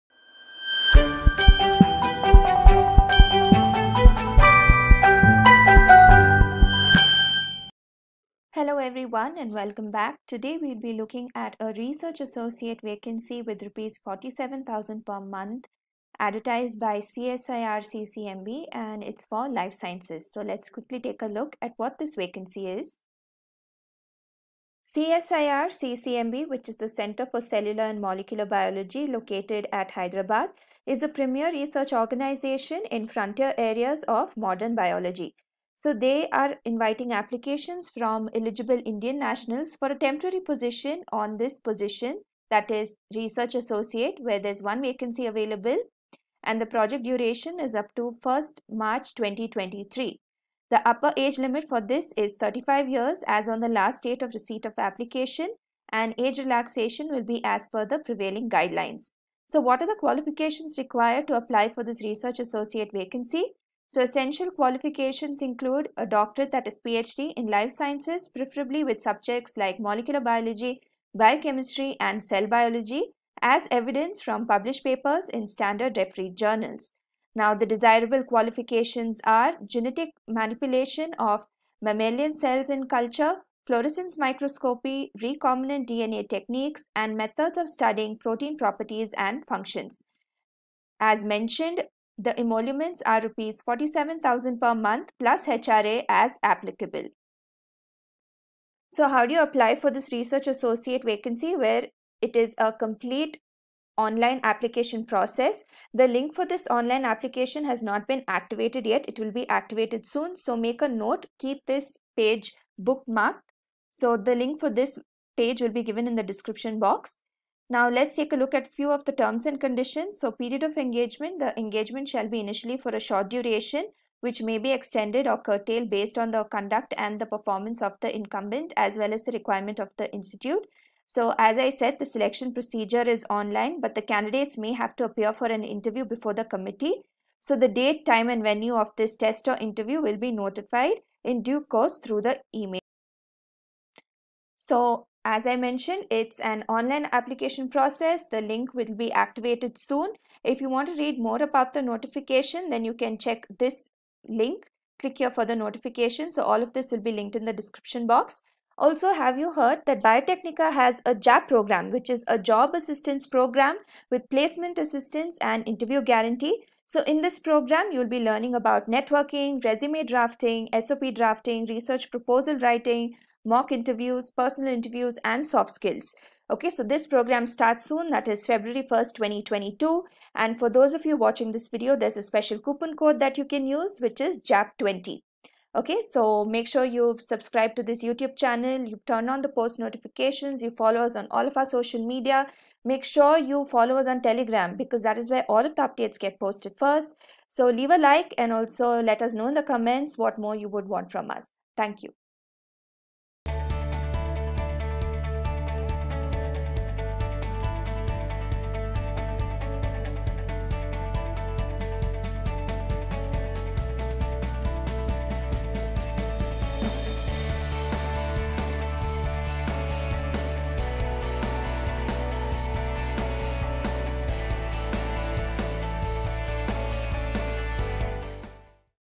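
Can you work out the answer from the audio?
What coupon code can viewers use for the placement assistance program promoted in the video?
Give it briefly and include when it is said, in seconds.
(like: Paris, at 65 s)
JAP20, at 184 s.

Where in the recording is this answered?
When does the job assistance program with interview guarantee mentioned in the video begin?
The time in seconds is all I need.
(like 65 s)
178 s.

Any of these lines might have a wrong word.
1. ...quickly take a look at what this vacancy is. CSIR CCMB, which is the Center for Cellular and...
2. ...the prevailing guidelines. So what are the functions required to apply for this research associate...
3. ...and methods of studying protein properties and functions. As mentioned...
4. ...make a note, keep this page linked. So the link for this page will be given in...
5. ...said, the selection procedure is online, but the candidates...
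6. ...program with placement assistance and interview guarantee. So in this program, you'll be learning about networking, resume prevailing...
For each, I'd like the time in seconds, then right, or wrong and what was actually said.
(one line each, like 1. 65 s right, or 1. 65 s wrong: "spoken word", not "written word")
1. 20 s right
2. 57 s wrong: "qualifications", not "functions"
3. 86 s right
4. 110 s wrong: "bookmarked", not "linked"
5. 131 s right
6. 163 s wrong: "drafting", not "prevailing".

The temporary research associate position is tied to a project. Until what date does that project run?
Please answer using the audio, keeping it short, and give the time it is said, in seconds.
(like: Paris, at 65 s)
1st March 2023, at 48 s.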